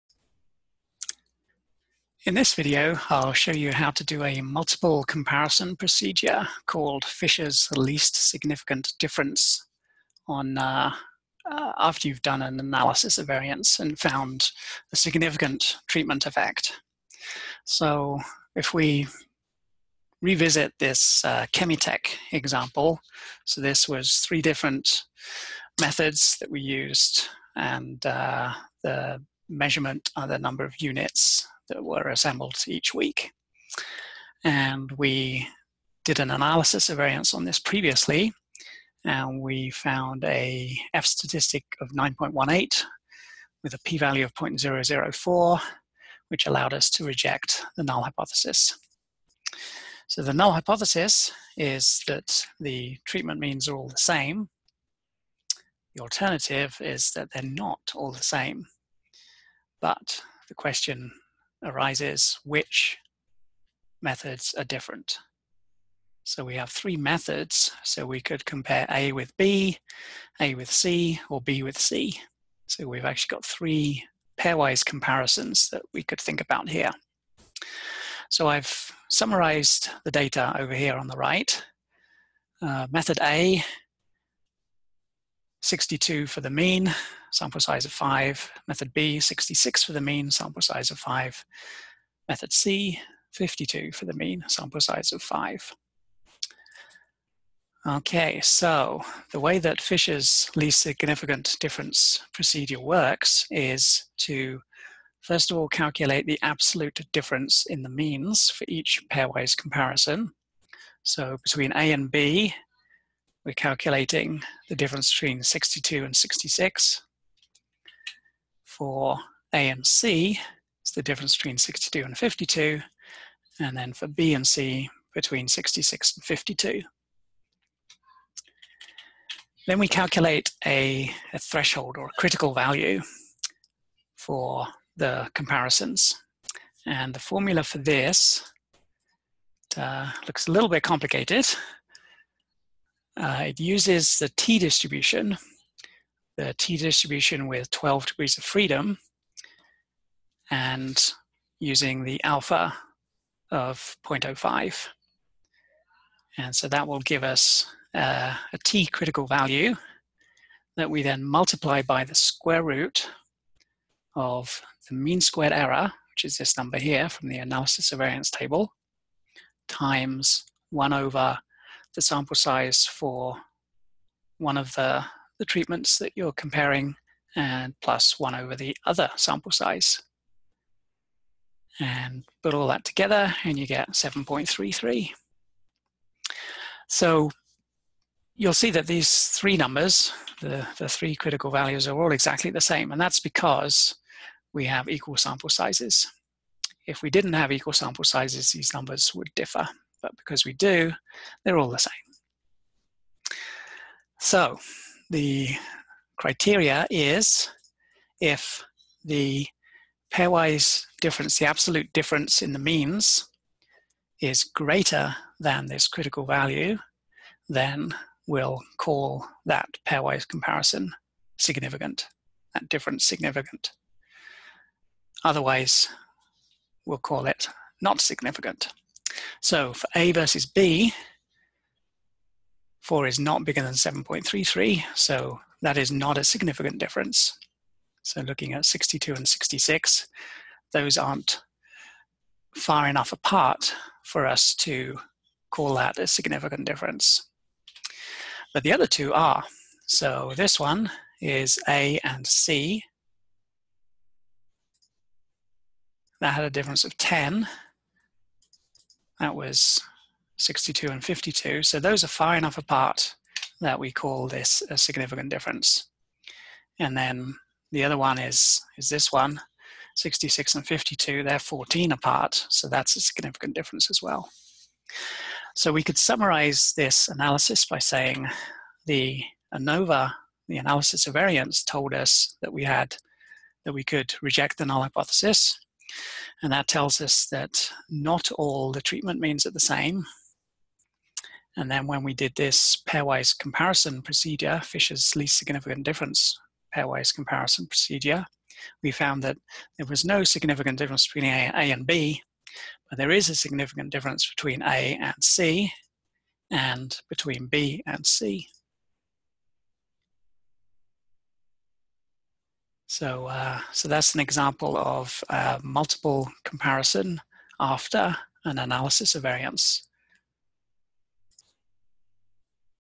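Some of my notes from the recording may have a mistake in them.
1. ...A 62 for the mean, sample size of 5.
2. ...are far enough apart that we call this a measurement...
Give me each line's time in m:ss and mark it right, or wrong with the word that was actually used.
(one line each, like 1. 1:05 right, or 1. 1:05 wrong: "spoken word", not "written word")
1. 1:23 right
2. 4:22 wrong: "significant", not "measurement".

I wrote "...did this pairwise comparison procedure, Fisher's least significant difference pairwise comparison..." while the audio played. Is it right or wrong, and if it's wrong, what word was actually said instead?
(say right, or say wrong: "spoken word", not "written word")
right.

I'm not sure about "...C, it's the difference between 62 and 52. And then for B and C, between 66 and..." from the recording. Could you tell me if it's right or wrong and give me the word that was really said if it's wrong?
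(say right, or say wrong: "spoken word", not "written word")
right.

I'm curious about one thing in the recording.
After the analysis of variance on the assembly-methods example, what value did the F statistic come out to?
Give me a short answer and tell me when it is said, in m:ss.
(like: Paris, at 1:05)
9.18, at 0:41.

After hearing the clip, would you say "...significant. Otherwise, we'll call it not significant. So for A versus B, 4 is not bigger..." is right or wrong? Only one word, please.
right.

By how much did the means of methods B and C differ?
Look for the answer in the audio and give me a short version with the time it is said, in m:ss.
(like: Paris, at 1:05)
14, at 4:31.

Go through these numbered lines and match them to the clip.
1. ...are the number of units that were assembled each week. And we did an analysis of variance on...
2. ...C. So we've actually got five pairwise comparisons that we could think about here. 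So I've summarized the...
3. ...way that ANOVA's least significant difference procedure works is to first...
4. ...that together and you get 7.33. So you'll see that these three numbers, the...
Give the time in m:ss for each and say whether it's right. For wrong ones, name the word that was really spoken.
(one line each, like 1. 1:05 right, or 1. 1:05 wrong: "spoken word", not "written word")
1. 0:30 right
2. 1:11 wrong: "three", not "five"
3. 1:39 wrong: "Fisher", not "ANOVA"
4. 3:02 right.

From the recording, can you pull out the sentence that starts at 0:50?
So the null hypothesis is that the treatment means are all the same.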